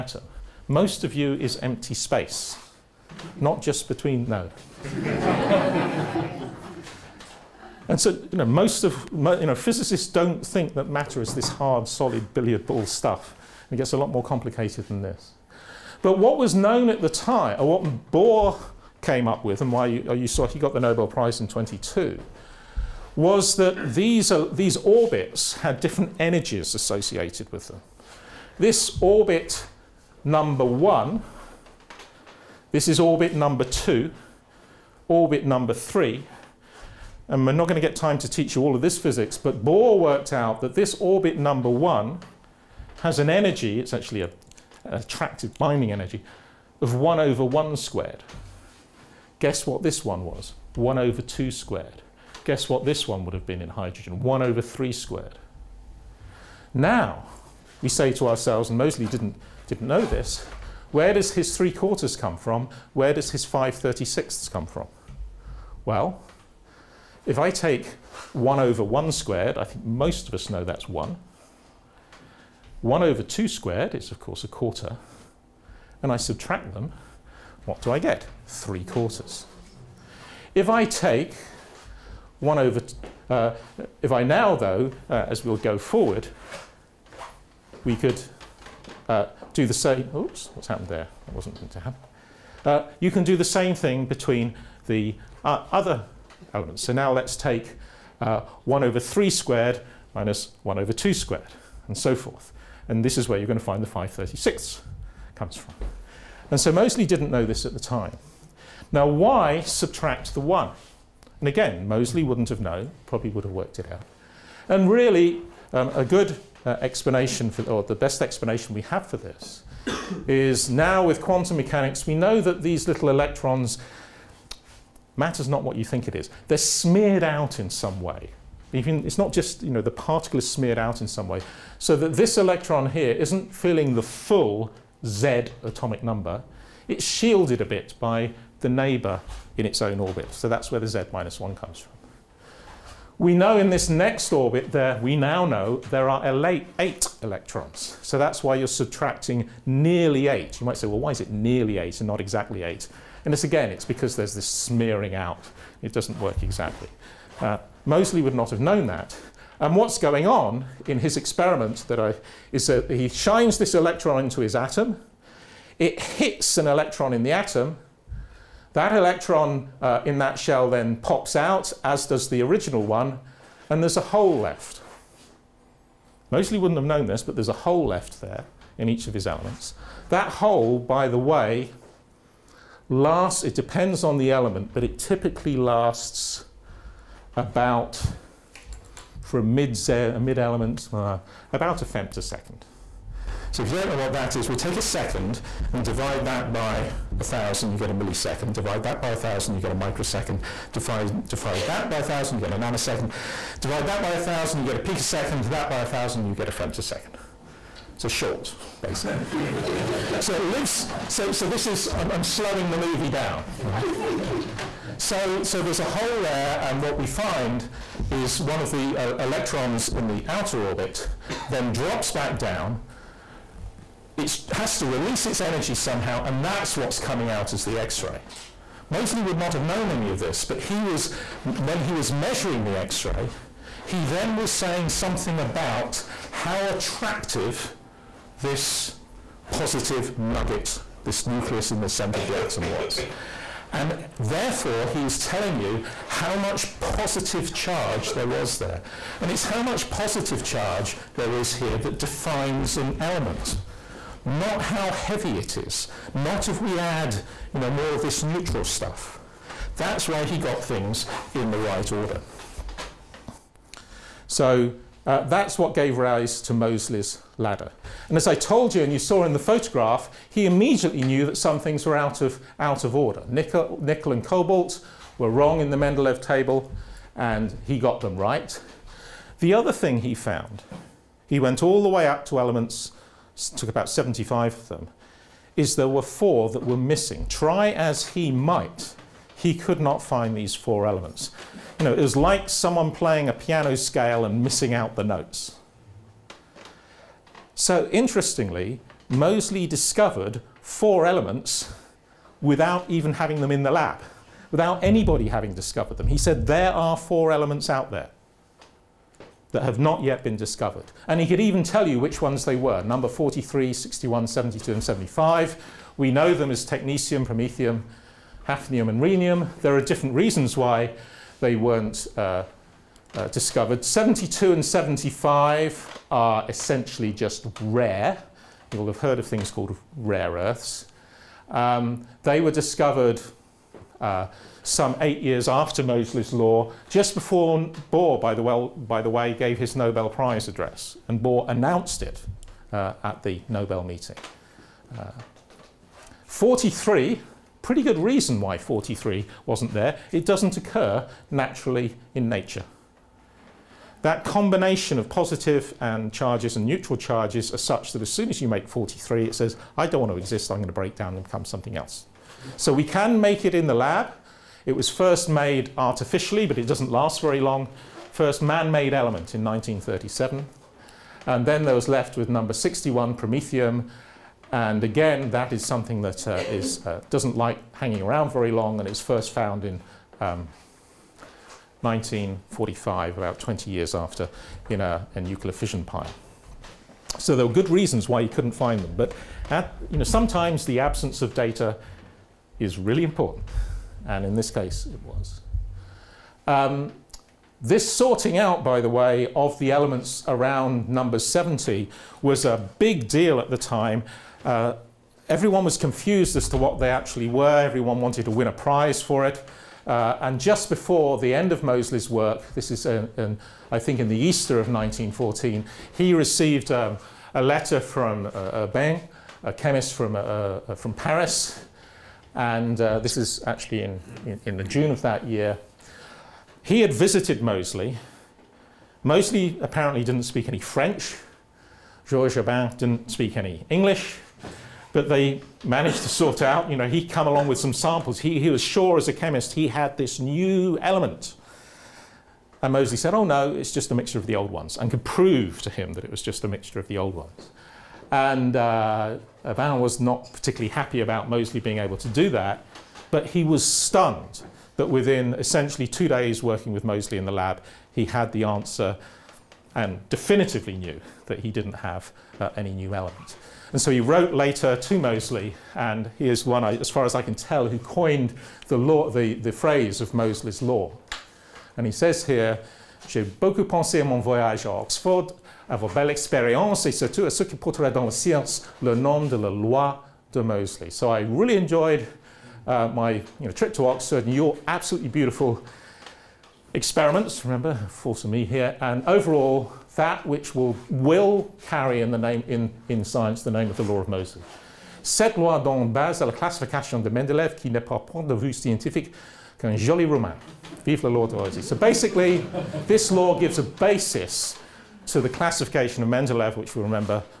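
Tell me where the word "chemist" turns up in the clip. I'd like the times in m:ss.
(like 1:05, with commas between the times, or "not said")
6:59, 7:19.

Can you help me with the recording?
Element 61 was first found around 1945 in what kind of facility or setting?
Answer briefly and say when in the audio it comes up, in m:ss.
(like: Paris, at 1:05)
a nuclear fission pile, at 6:25.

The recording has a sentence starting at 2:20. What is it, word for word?
So that's where the Z minus 1 comes from.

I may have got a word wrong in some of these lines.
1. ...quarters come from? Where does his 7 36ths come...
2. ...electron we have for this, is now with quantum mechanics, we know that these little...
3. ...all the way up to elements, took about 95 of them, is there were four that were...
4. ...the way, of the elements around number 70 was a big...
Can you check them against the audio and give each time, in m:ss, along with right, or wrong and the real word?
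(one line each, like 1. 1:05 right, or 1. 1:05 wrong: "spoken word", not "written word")
1. 1:01 wrong: "5", not "7"
2. 1:58 wrong: "explanation", not "electron"
3. 4:41 wrong: "75", not "95"
4. 6:38 right.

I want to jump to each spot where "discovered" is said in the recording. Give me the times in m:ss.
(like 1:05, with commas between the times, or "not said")
4:59, 5:05, 5:10, 5:23, 5:32.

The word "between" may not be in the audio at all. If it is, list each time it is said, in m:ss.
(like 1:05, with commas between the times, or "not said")
0:03, 1:34.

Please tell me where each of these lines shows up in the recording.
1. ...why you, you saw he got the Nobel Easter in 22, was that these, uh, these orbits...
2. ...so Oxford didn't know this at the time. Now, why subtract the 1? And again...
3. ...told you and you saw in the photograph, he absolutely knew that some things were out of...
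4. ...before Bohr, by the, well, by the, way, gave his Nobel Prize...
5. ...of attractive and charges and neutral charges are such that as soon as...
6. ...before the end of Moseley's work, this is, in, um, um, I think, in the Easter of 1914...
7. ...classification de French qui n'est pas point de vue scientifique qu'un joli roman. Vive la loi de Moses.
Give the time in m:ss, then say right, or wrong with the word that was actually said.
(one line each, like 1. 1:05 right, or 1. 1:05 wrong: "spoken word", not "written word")
1. 0:19 wrong: "Prize", not "Easter"
2. 1:46 wrong: "Moseley", not "Oxford"
3. 4:28 wrong: "immediately", not "absolutely"
4. 5:37 right
5. 5:54 wrong: "positive", not "attractive"
6. 6:50 right
7. 8:16 wrong: "Mendeleev", not "French".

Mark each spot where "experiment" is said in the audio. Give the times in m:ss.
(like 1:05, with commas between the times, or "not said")
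2:41, 8:06.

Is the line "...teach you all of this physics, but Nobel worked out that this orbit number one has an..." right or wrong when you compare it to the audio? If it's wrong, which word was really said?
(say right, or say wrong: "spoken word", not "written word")
wrong: "Bohr", not "Nobel".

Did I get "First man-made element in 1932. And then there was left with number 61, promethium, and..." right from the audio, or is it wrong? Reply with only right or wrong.
wrong.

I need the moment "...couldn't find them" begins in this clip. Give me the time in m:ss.
6:28.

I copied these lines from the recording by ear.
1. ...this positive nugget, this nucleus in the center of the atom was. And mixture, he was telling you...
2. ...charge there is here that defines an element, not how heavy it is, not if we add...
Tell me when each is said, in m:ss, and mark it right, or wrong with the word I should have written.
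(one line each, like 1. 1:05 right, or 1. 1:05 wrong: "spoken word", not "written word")
1. 3:58 wrong: "therefore", not "mixture"
2. 4:10 right.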